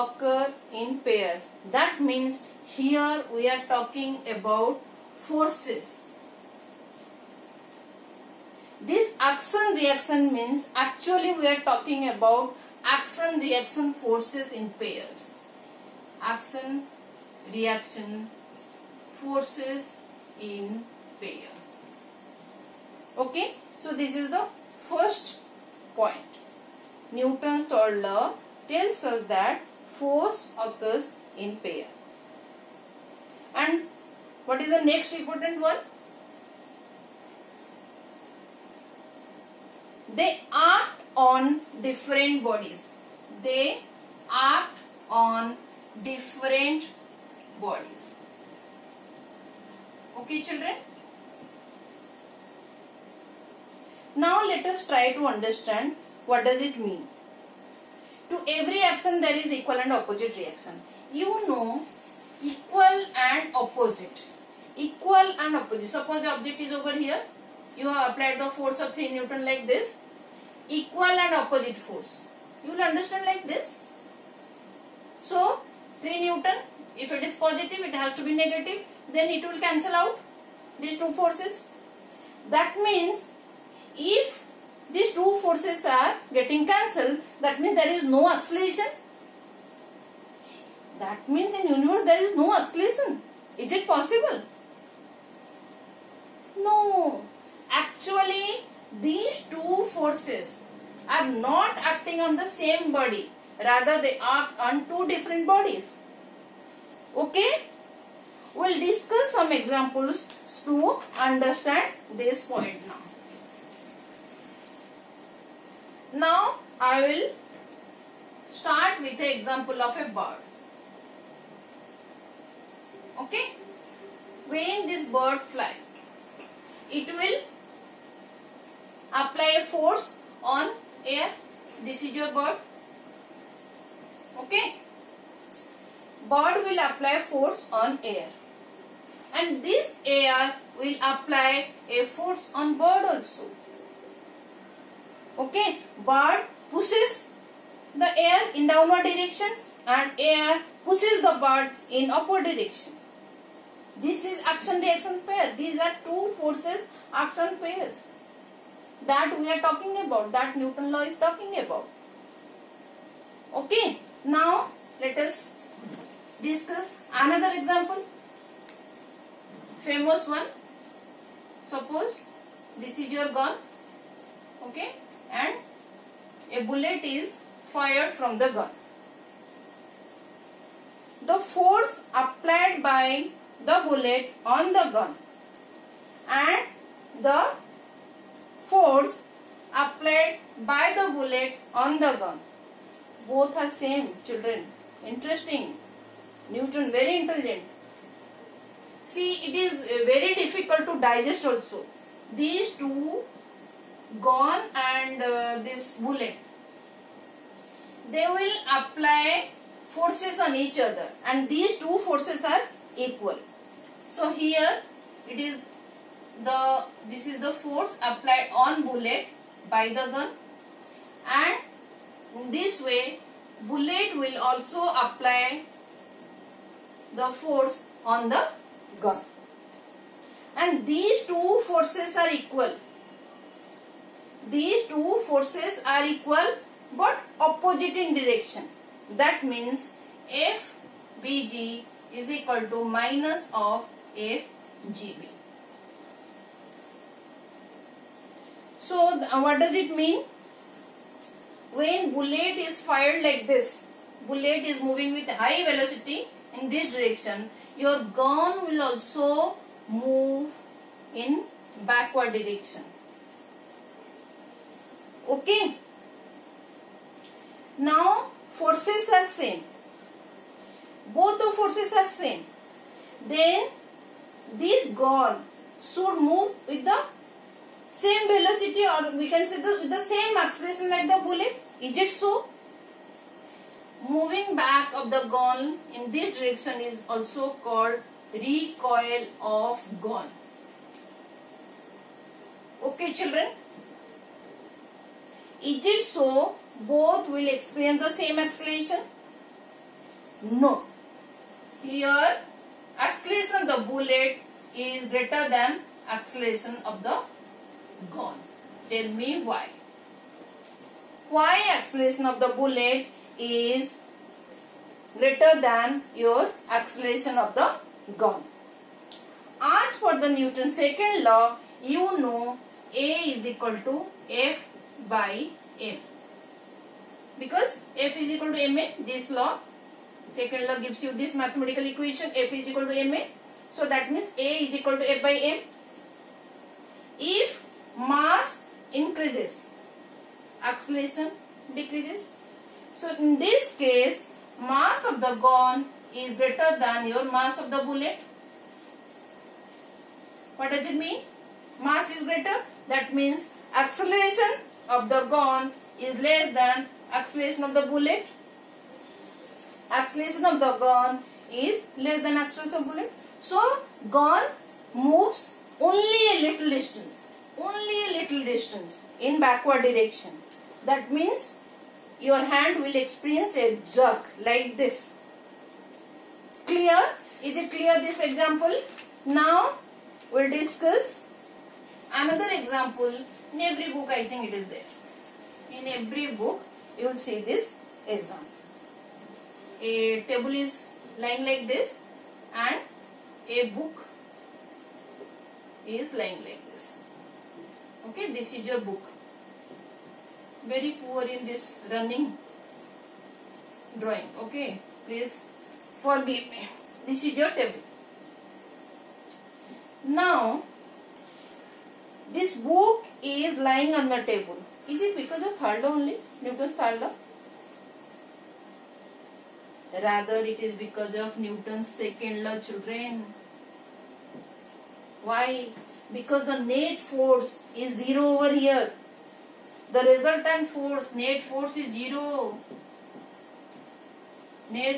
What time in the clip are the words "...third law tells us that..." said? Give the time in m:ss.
0:27.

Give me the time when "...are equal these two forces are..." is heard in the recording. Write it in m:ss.
3:52.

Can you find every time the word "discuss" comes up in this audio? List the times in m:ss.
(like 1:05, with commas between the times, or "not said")
1:48, 2:46, 6:20.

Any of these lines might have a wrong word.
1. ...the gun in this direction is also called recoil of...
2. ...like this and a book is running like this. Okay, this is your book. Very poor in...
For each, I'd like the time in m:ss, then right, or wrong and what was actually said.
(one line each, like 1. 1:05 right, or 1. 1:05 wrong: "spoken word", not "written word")
1. 4:45 right
2. 6:31 wrong: "lying", not "running".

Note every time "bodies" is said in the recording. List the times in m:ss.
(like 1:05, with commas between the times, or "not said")
0:42, 0:47, 1:45.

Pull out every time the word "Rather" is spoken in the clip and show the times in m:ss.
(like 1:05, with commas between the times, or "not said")
1:43, 7:00.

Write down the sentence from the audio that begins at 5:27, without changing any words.
Because F is equal to MA, this law, second law gives you this mathematical equation F is equal to MA.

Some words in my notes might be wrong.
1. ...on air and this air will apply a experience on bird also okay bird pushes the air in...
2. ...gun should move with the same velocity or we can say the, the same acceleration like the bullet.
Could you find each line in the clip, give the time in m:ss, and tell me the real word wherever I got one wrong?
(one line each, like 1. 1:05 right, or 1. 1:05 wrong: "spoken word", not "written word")
1. 2:17 wrong: "force", not "experience"
2. 4:35 right.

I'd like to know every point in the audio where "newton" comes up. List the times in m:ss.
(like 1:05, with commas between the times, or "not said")
0:27, 1:09, 1:16, 2:40, 3:16, 5:20, 6:56, 7:01.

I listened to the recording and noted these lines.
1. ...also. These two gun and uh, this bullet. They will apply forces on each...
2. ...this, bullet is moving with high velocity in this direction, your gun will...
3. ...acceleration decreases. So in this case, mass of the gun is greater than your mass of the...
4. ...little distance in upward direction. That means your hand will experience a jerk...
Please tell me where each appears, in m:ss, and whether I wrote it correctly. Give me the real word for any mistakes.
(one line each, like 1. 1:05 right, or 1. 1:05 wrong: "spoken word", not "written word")
1. 3:21 right
2. 4:13 right
3. 5:40 right
4. 6:08 wrong: "backward", not "upward".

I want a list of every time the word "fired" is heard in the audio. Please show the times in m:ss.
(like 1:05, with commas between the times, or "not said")
2:57, 4:12.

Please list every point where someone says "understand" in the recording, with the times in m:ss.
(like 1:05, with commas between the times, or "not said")
0:55, 1:12, 1:51.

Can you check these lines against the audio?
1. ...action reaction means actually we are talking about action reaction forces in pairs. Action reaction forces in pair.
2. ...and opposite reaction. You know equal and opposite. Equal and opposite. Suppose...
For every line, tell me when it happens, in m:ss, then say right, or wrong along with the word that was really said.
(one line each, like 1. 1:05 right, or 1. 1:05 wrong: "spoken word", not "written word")
1. 0:09 right
2. 0:59 right.